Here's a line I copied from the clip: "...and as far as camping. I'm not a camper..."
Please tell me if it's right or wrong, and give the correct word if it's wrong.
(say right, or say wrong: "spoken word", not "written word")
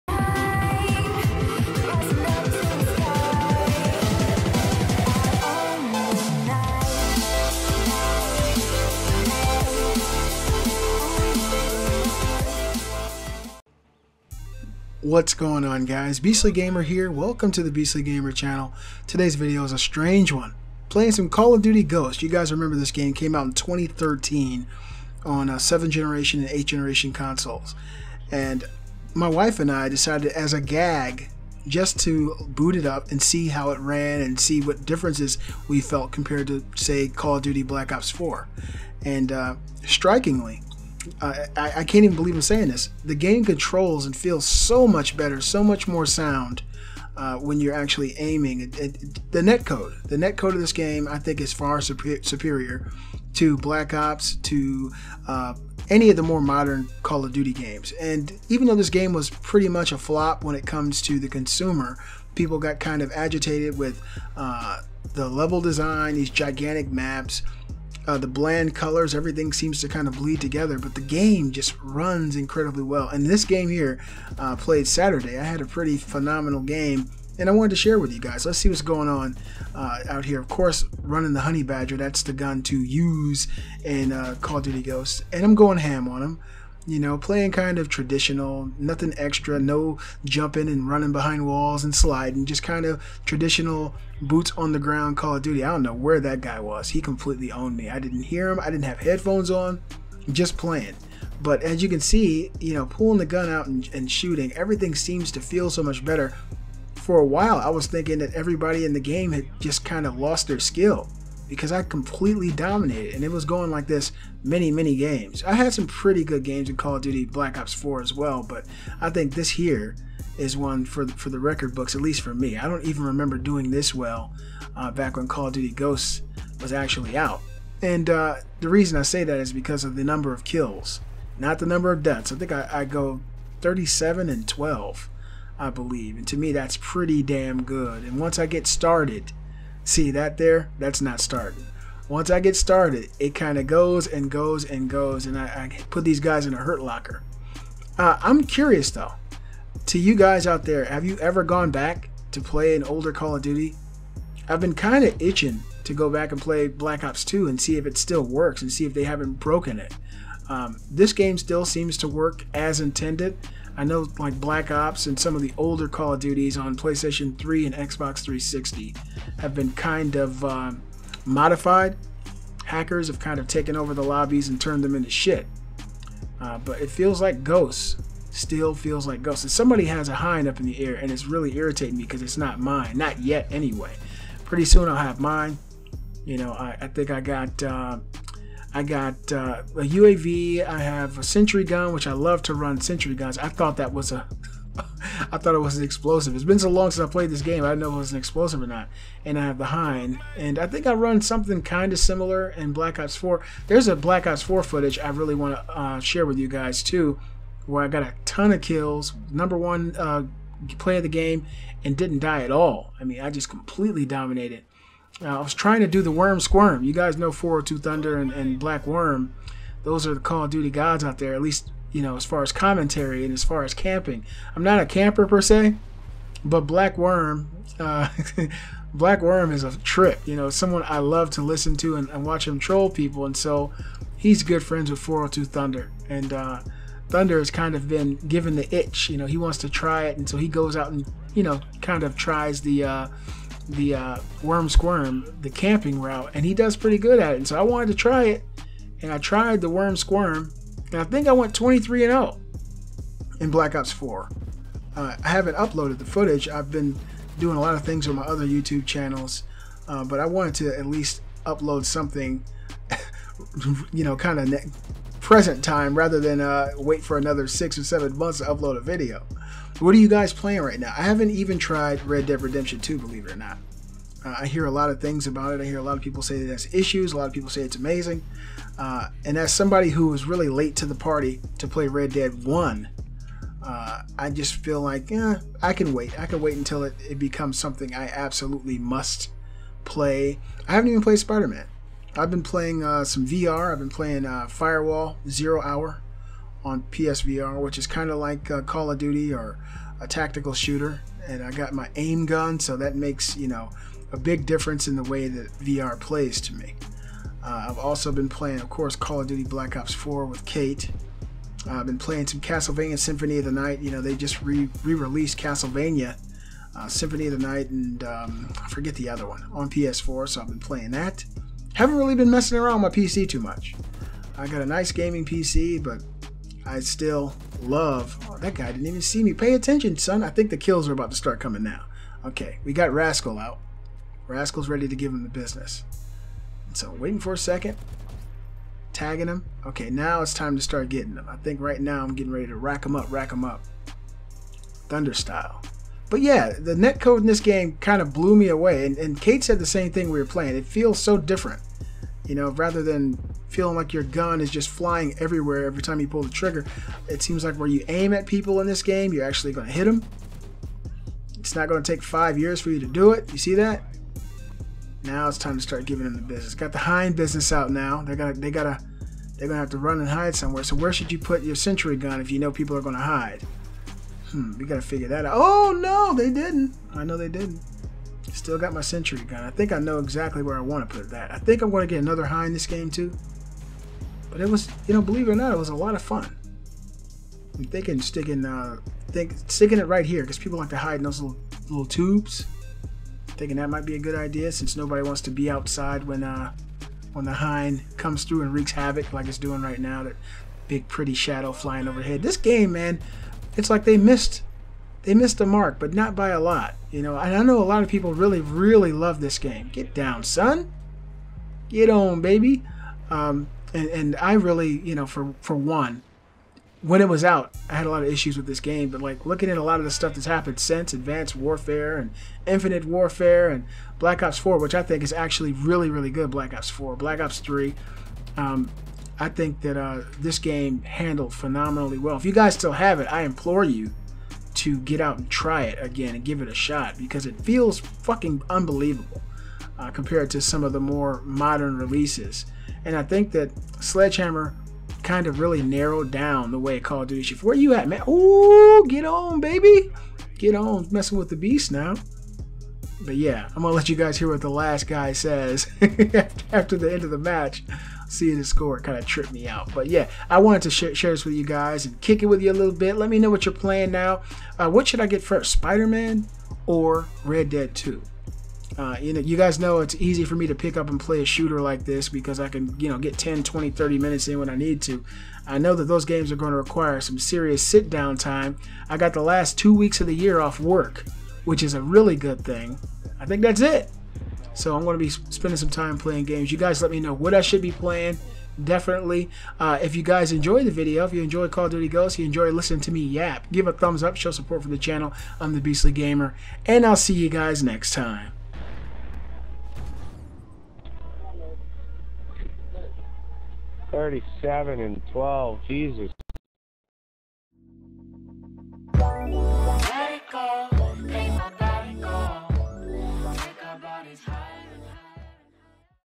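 right.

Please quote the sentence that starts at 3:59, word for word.
You know, he wants to try it.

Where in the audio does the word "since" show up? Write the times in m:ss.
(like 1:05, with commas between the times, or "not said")
3:16, 6:34, 7:00.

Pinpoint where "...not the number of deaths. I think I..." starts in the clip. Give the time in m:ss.
2:11.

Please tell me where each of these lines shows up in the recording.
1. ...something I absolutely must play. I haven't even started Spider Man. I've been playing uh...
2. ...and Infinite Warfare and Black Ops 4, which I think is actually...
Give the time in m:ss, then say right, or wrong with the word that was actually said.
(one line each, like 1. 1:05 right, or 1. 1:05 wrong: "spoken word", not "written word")
1. 4:47 wrong: "played", not "started"
2. 7:01 right.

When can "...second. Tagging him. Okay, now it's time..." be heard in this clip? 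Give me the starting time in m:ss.
5:37.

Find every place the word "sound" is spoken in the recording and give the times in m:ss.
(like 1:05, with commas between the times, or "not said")
0:46.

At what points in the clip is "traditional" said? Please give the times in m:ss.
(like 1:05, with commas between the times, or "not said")
1:27, 1:33.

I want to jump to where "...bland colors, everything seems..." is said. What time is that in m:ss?
1:08.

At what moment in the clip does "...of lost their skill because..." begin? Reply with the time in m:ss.
1:50.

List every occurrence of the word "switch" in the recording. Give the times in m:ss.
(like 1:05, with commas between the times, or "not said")
not said.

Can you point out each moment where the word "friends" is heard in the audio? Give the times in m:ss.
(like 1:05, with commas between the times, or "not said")
3:54.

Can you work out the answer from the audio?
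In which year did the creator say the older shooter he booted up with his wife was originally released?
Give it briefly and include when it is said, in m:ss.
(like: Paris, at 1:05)
2013, at 0:23.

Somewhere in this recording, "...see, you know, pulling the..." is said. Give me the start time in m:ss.
1:41.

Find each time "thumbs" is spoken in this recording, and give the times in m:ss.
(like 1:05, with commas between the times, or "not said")
8:13.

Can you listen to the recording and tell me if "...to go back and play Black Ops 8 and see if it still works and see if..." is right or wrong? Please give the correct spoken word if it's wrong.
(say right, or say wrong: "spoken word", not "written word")
wrong: "2", not "8".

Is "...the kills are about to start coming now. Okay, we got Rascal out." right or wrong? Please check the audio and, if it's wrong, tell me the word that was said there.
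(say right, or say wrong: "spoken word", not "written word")
right.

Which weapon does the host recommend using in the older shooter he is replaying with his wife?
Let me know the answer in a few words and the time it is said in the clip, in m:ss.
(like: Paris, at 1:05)
Honey Badger, at 1:21.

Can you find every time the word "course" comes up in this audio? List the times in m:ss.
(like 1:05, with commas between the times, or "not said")
1:20, 5:08.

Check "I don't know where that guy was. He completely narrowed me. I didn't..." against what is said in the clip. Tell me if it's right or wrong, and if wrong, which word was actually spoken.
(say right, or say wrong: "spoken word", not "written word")
wrong: "owned", not "narrowed".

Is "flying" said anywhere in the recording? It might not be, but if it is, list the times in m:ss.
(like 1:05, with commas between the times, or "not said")
5:54, 6:41.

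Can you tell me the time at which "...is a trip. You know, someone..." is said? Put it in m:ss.
3:49.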